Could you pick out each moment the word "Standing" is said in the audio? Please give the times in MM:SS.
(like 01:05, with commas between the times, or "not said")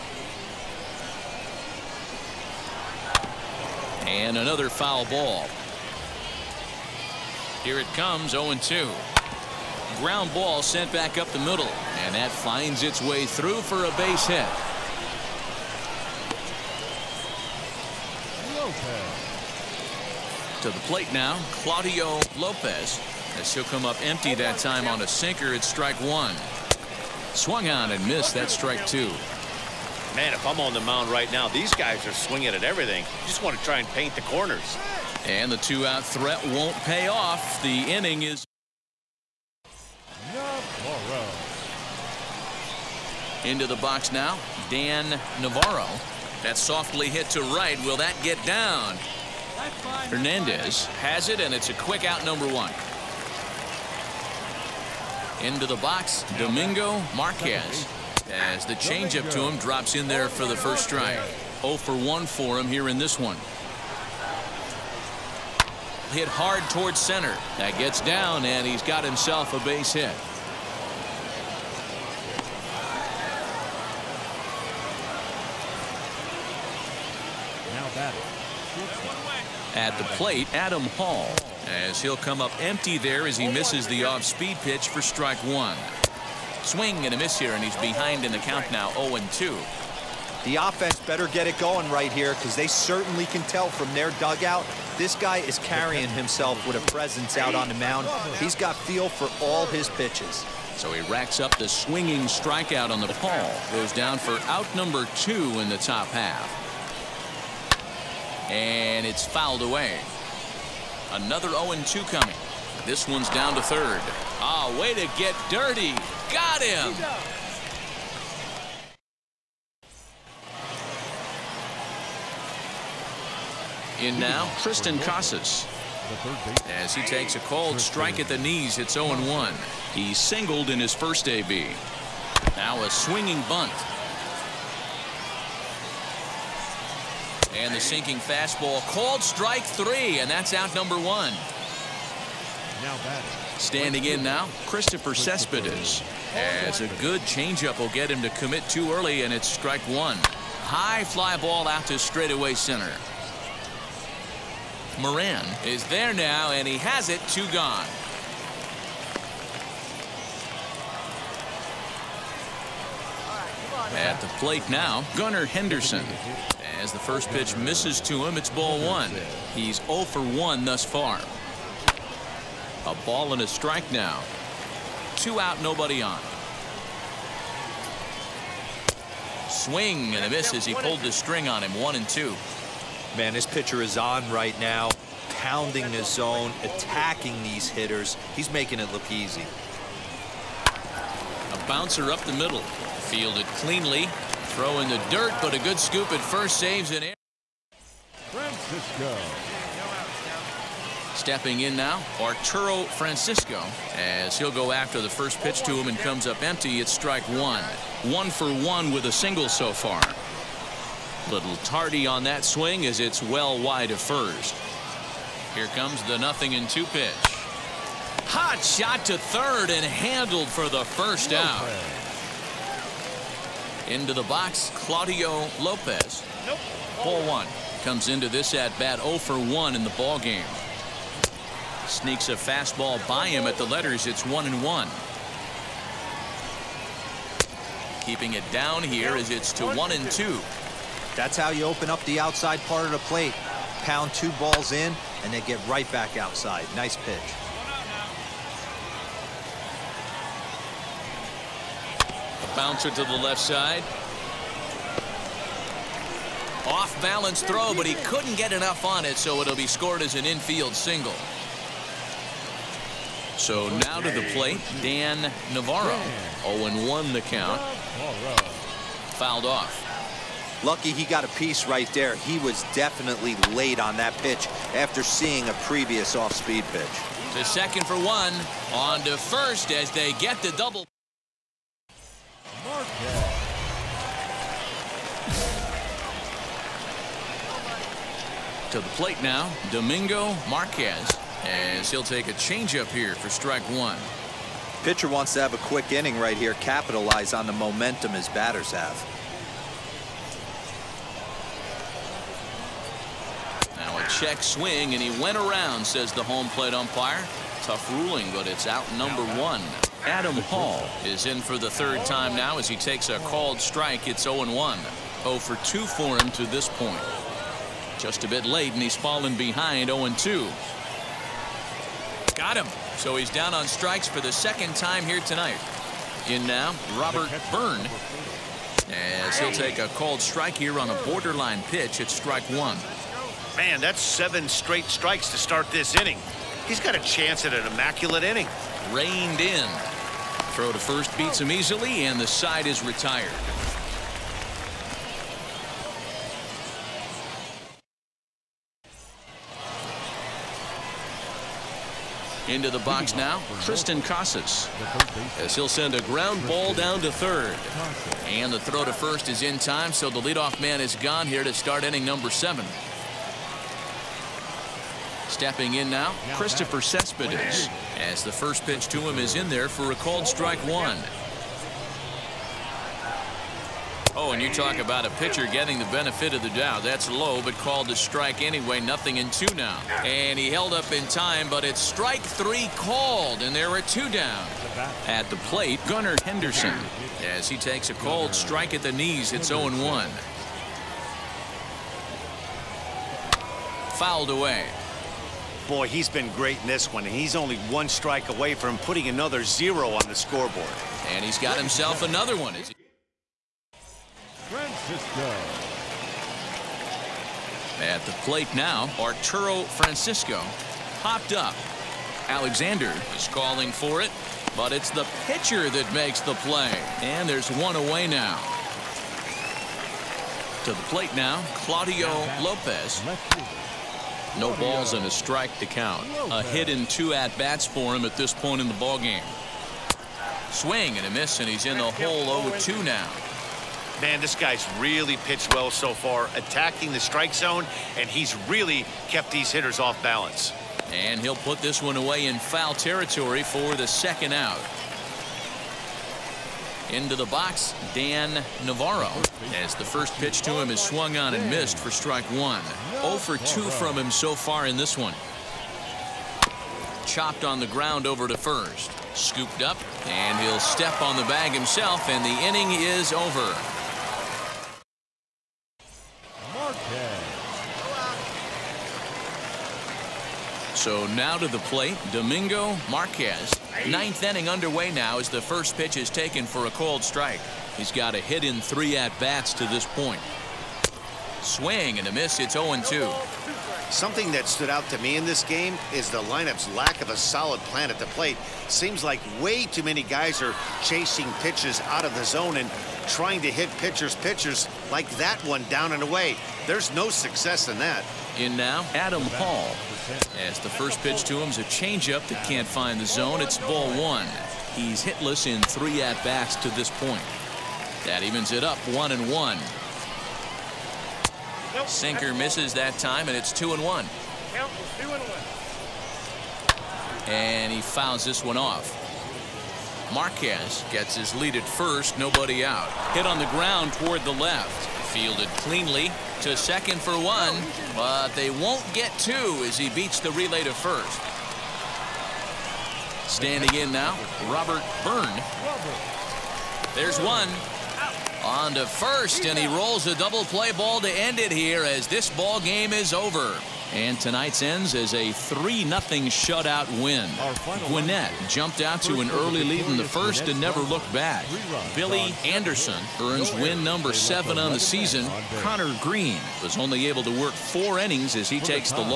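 02:23, 08:53.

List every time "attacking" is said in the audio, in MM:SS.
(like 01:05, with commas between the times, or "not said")
03:06, 07:16.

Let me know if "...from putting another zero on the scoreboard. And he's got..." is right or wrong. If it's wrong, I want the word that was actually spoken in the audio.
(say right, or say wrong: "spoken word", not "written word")
right.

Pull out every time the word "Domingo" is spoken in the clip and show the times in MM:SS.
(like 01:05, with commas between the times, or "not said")
00:56, 04:49, 07:52.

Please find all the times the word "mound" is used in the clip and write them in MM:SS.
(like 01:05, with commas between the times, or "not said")
00:30, 01:37.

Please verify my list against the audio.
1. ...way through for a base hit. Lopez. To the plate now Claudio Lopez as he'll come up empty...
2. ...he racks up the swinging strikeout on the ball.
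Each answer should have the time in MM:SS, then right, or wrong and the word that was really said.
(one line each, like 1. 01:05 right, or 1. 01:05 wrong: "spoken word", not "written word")
1. 00:13 right
2. 01:40 right.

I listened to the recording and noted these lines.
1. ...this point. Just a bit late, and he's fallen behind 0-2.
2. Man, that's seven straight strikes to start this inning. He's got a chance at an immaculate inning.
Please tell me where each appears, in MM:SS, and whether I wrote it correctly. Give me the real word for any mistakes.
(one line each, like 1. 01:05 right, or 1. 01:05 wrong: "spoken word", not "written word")
1. 05:16 right
2. 05:33 right.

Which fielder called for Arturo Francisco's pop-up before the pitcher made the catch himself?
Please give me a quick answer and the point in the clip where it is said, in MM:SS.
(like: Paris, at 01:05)
Alexander, at 06:52.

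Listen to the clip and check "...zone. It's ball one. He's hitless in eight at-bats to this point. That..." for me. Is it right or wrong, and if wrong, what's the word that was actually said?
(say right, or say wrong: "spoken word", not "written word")
wrong: "three", not "eight".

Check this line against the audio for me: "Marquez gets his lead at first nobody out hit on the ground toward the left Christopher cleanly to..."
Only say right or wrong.
wrong.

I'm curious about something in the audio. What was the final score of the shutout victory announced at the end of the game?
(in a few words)
3-0.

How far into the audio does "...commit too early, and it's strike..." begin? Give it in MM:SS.
02:28.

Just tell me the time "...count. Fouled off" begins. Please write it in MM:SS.
04:27.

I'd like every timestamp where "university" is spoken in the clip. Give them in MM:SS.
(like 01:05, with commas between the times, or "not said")
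not said.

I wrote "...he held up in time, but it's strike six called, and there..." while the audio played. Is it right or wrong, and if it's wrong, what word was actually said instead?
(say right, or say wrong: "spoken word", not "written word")
wrong: "three", not "six".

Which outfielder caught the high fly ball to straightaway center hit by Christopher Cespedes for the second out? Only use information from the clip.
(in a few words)
Moran.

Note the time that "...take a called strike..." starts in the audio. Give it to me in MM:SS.
05:29.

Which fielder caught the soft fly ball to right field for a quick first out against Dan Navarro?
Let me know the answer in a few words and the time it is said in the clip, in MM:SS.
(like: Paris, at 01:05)
Hernandez, at 00:50.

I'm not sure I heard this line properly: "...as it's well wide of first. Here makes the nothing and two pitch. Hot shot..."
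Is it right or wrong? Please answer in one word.
wrong.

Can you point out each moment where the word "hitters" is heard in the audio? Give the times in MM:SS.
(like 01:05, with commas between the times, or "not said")
03:07, 07:19.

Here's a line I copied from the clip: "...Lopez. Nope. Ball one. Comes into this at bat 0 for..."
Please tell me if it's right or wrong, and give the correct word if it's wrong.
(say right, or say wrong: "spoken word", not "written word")
right.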